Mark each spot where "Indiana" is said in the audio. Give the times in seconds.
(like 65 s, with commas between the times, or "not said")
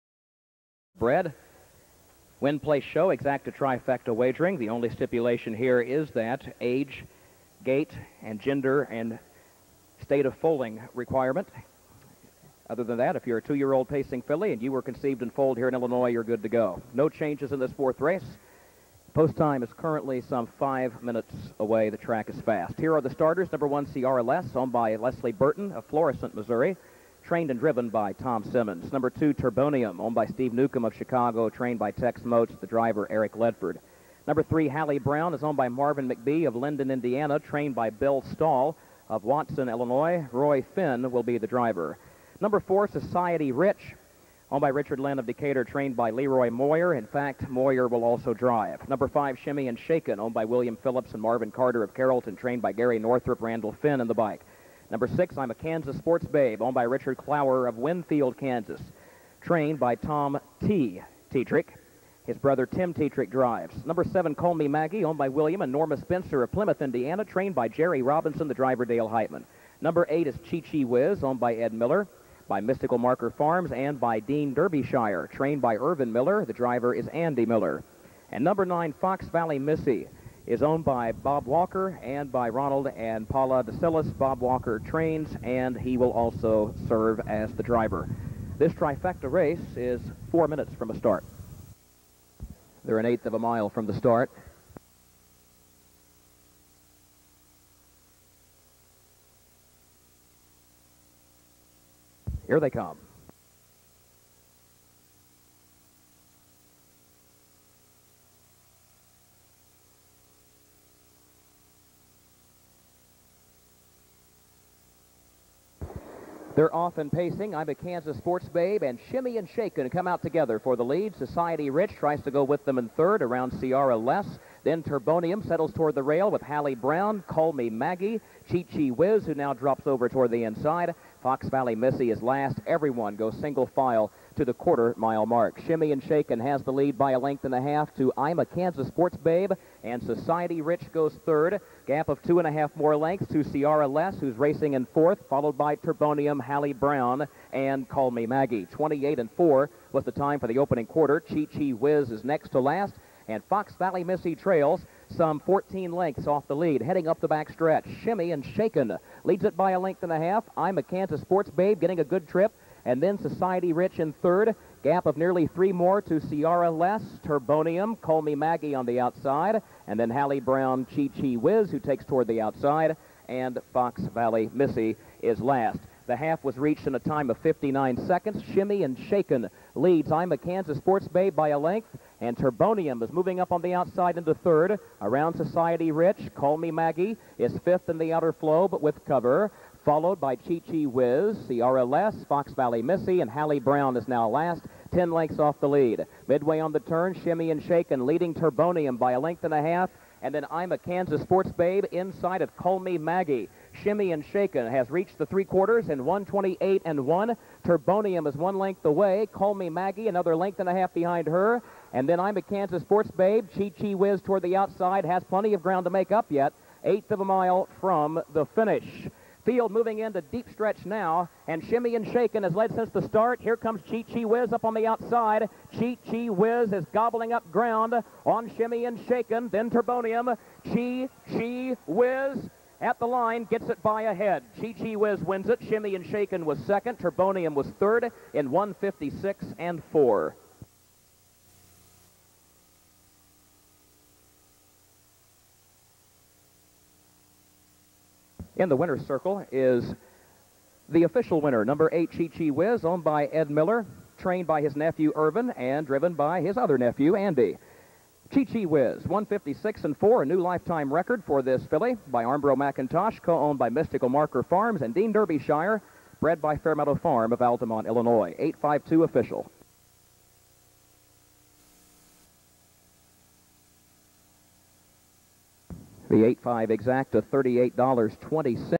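36 s, 66 s.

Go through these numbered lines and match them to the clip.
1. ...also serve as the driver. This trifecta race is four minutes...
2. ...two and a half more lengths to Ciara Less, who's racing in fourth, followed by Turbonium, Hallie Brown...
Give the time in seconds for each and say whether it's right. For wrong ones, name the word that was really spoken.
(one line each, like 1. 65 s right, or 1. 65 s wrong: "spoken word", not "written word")
1. 86 s right
2. 142 s right.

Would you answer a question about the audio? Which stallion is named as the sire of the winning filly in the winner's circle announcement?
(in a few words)
Armbro McIntosh.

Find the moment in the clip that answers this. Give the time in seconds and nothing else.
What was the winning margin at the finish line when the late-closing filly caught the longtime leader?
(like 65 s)
233 s.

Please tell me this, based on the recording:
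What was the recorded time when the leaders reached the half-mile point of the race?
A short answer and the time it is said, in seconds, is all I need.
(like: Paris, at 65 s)
59 seconds, at 177 s.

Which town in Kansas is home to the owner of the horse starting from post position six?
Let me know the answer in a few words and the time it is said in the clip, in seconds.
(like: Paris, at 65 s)
Winfield, at 57 s.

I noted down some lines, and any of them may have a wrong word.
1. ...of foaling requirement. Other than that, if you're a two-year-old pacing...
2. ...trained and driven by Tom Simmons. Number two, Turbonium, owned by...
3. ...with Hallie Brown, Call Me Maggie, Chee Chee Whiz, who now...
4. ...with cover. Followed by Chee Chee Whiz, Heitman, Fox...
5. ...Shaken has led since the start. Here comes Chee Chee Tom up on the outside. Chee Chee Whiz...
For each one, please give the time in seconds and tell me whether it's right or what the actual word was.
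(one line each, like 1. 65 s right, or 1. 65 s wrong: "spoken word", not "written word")
1. 10 s right
2. 27 s right
3. 126 s right
4. 188 s wrong: "CRLS", not "Heitman"
5. 222 s wrong: "Whiz", not "Tom".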